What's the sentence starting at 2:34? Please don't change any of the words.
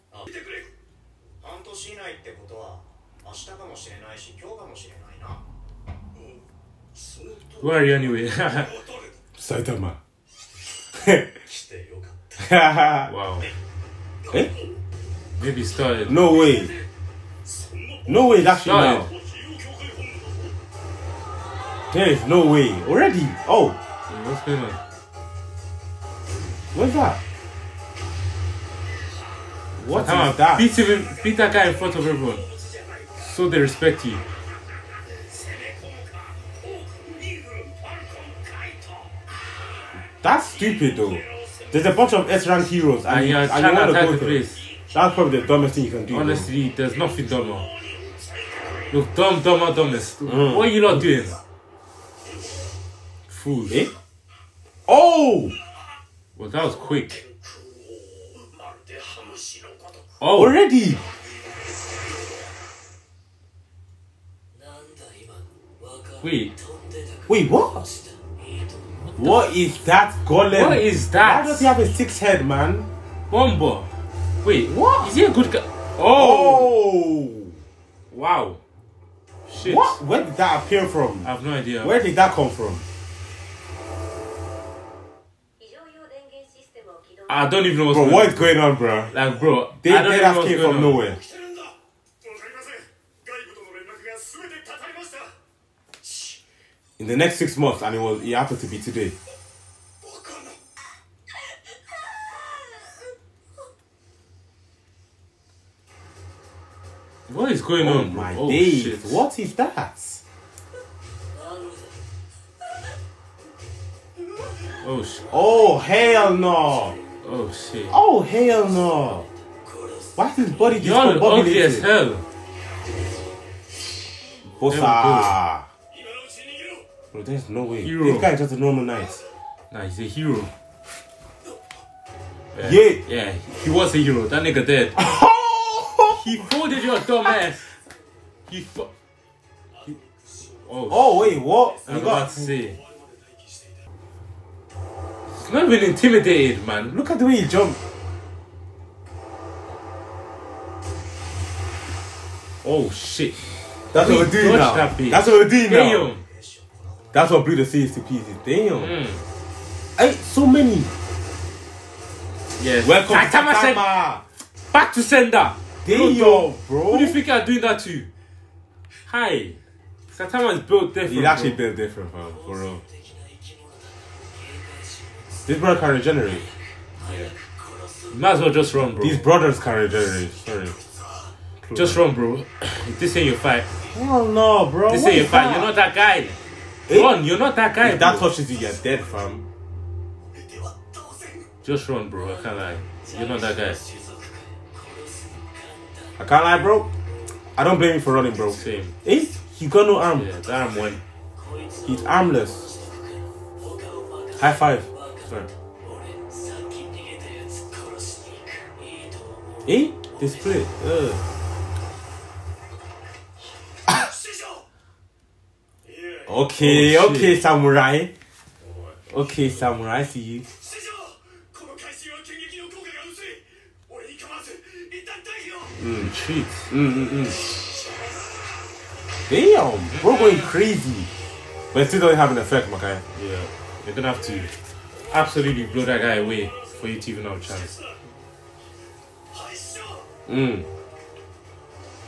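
That That's what we're doing Damn.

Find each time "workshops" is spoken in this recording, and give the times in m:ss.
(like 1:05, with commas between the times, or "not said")
not said.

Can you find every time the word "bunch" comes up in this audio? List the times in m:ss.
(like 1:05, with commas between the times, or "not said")
0:41.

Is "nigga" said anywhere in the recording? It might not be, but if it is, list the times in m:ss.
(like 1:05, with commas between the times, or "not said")
2:14.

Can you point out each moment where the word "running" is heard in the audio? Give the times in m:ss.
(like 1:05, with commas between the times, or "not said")
3:18.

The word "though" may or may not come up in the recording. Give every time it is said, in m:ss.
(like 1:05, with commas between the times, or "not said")
0:40, 0:46.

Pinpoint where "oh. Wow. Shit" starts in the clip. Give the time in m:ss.
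1:17.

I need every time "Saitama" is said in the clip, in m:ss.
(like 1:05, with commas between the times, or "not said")
0:09, 2:43, 2:50.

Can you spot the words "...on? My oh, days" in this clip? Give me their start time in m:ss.
1:47.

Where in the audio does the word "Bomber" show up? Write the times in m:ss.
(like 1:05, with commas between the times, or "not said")
1:13.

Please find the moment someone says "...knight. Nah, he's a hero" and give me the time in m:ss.
2:08.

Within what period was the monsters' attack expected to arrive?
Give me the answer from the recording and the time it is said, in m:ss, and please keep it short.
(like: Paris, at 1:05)
6 months, at 1:37.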